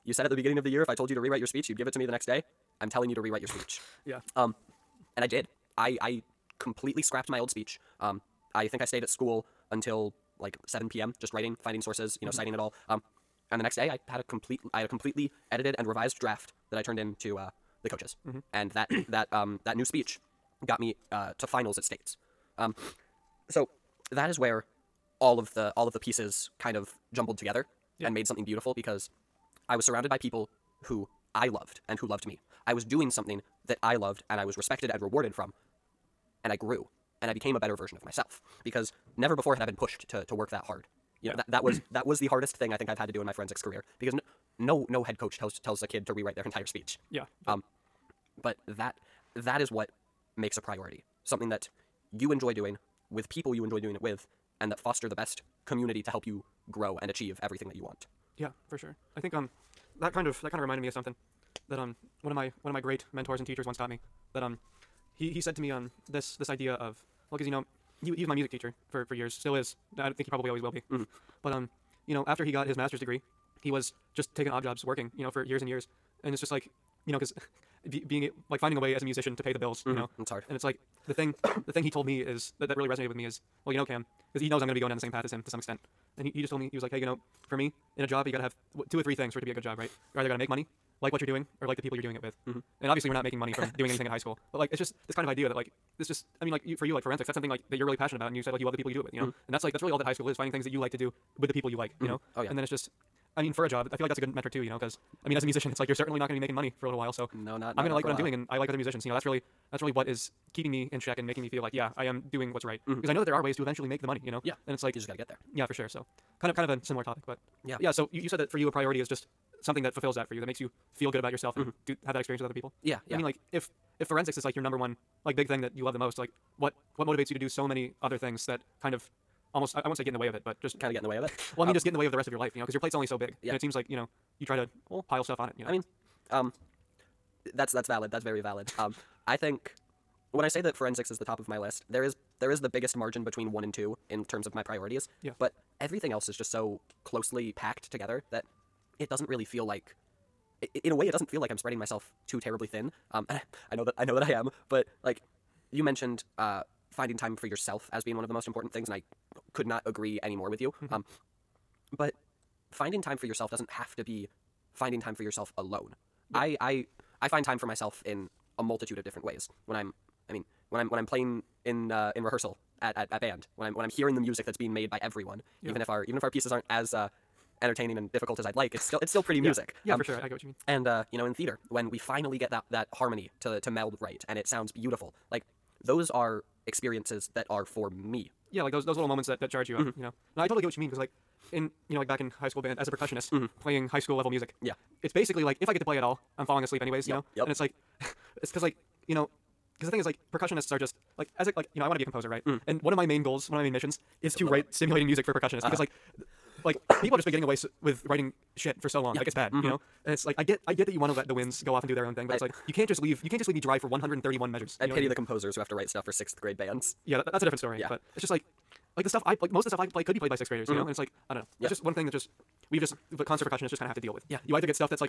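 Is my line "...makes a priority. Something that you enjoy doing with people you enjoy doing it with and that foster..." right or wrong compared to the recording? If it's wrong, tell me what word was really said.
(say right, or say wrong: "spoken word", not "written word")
right.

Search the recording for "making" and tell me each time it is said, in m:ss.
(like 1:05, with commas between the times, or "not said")
1:33, 1:46, 1:51.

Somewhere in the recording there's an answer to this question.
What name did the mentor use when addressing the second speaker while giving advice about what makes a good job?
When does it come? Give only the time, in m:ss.
1:23.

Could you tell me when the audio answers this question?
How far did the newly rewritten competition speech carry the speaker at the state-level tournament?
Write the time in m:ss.
0:21.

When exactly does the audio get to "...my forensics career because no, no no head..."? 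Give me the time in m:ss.
0:43.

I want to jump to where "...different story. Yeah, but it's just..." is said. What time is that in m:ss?
3:37.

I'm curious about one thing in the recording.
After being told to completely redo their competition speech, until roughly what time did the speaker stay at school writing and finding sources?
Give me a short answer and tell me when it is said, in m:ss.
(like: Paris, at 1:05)
7 p.m., at 0:10.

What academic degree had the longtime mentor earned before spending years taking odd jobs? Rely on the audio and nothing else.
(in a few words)
Master's degree.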